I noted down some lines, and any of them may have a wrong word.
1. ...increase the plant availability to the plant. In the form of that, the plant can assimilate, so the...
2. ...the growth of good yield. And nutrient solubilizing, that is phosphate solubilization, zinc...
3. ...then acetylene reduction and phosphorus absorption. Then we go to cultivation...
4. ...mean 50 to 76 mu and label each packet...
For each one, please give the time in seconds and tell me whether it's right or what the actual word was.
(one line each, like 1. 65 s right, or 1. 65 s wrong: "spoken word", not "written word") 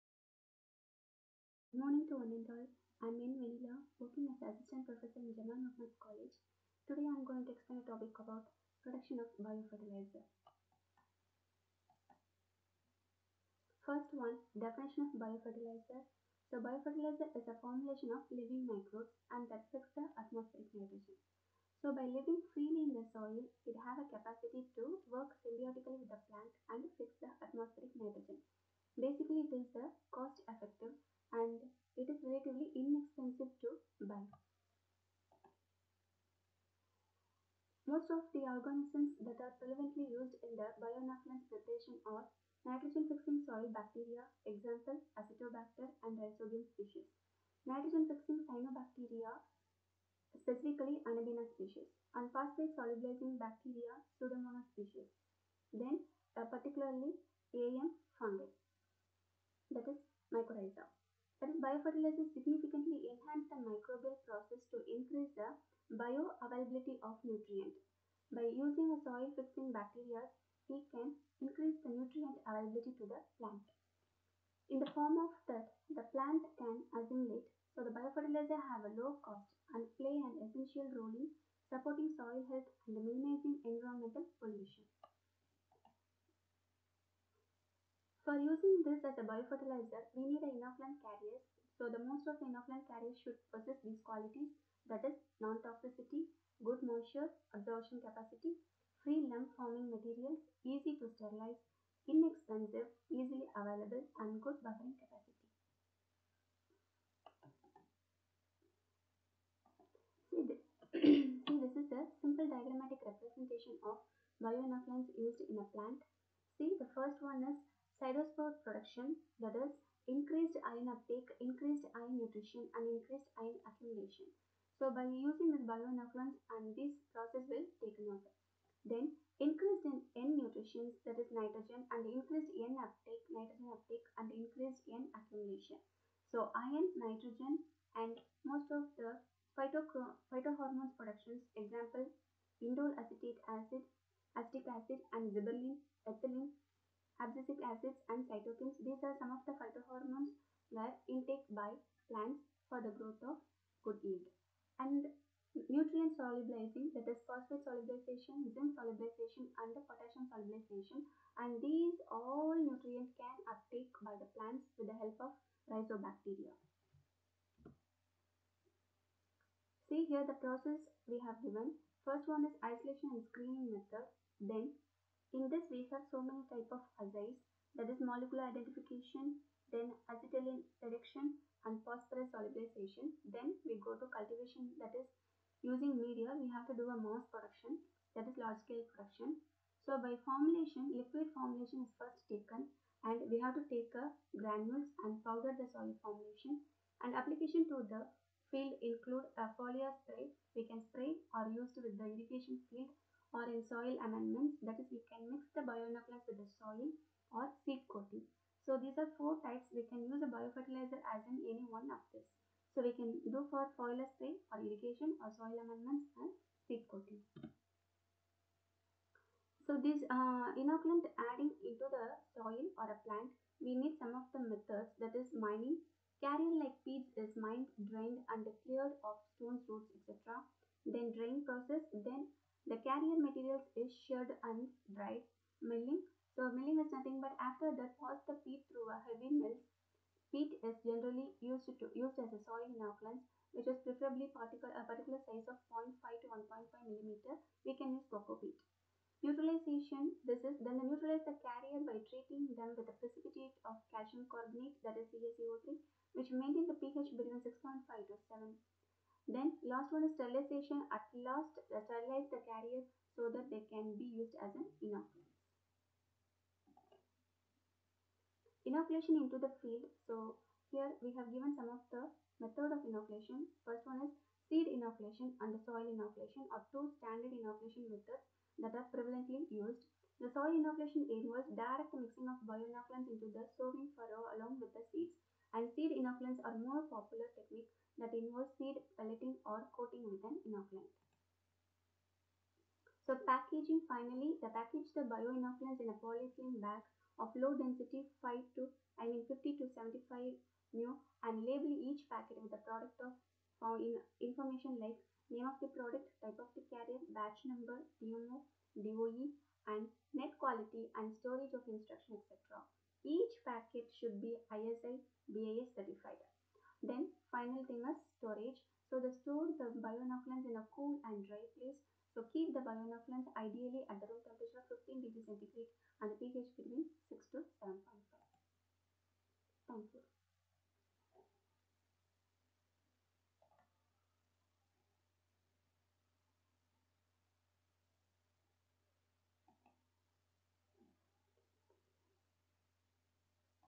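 1. 71 s wrong: "nutrient", not "plant"
2. 152 s right
3. 179 s wrong: "solubilization", not "absorption"
4. 299 s wrong: "75", not "76".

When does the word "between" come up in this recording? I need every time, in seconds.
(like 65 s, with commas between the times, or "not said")
257 s, 326 s.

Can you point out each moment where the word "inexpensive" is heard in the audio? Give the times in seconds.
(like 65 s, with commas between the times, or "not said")
32 s, 102 s.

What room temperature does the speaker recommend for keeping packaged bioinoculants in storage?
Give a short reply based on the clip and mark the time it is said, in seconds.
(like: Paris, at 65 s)
15 degrees centigrade, at 324 s.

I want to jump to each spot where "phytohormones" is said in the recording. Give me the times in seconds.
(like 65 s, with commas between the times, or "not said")
139 s, 149 s.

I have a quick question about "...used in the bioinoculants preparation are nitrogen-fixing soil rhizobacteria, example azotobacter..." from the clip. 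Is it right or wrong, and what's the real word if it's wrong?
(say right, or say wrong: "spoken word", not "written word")
wrong: "bacteria", not "rhizobacteria".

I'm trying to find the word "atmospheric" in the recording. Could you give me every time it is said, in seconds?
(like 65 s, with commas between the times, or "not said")
20 s, 27 s.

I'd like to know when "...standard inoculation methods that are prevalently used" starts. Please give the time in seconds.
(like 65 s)
276 s.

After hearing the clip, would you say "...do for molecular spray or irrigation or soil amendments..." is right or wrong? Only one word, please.
wrong.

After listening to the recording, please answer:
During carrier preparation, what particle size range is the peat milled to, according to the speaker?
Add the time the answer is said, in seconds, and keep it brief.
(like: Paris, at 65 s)
0.5 to 1.5 mm, at 245 s.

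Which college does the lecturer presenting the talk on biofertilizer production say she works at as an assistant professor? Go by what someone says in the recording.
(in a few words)
Jamal Mohamed College.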